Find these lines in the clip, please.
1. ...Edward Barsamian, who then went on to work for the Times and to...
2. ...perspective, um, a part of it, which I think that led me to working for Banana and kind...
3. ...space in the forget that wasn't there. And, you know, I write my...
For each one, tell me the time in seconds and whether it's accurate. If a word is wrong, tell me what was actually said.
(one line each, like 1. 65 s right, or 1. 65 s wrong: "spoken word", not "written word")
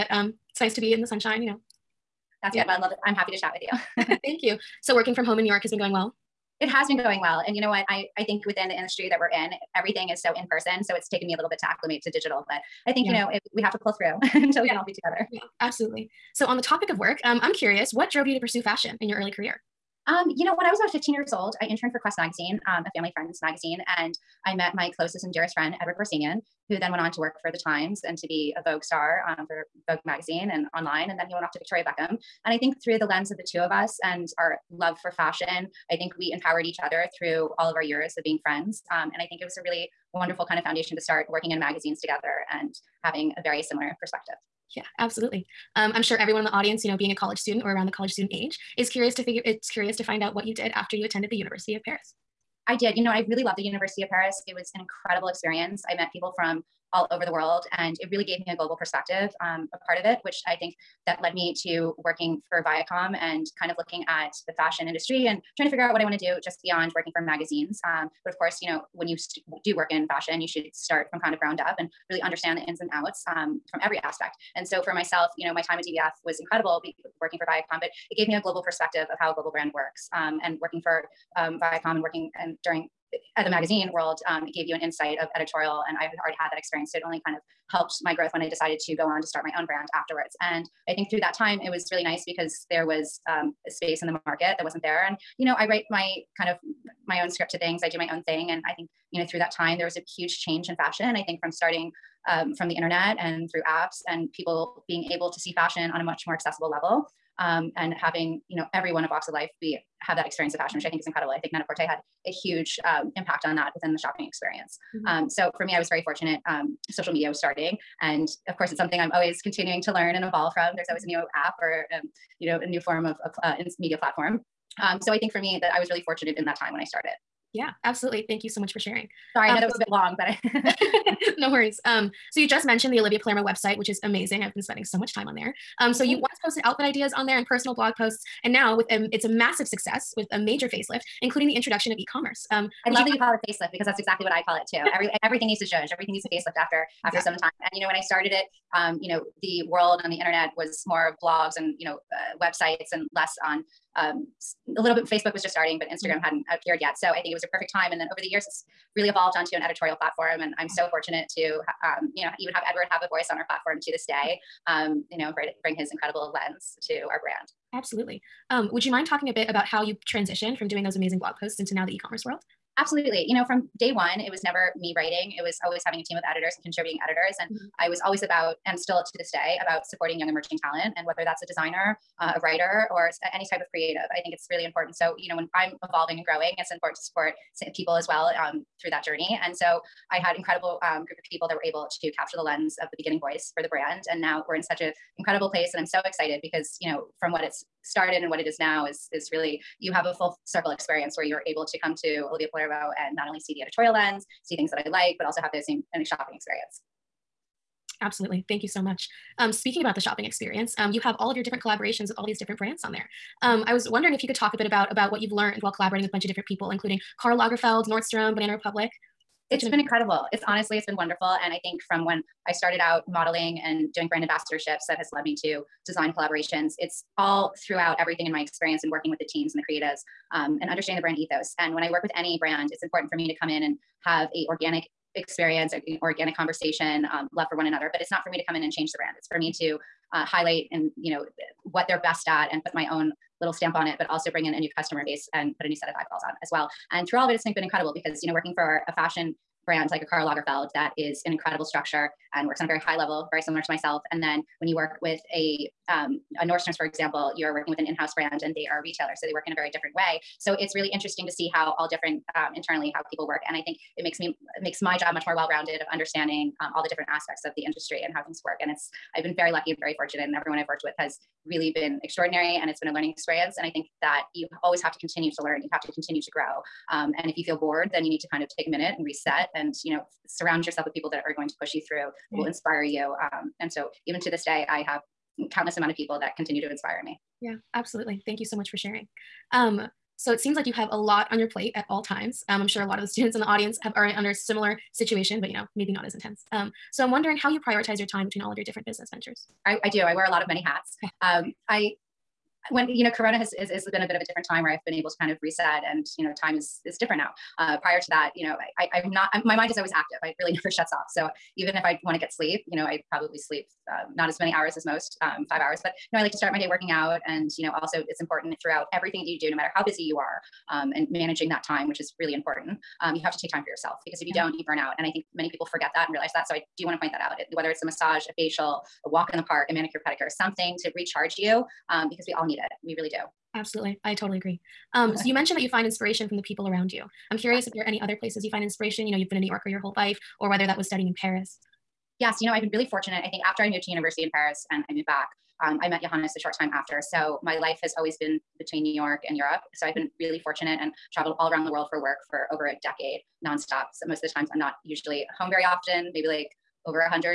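1. 25 s right
2. 58 s wrong: "Viacom", not "Banana"
3. 93 s wrong: "market", not "forget".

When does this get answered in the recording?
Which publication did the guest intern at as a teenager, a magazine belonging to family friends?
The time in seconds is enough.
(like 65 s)
22 s.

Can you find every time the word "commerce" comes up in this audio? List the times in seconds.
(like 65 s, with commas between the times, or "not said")
141 s, 171 s.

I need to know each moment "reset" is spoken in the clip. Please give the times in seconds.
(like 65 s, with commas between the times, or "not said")
279 s, 305 s.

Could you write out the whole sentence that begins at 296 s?
Um, so I'm wondering how you prioritize your time between all of your different business ventures.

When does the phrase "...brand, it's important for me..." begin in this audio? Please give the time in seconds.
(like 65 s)
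232 s.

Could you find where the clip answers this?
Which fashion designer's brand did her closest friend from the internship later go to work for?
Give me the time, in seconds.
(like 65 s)
31 s.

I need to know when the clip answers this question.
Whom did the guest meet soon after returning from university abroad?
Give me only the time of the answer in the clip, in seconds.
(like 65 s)
346 s.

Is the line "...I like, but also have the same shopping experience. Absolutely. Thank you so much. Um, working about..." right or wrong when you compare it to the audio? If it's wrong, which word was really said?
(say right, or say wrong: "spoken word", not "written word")
wrong: "speaking", not "working".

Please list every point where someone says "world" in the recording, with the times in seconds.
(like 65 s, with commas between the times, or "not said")
57 s, 83 s, 149 s, 172 s, 351 s.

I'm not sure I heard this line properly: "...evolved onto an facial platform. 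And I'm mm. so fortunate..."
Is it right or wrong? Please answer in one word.
wrong.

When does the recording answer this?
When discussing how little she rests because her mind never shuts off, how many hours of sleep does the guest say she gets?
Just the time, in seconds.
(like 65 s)
315 s.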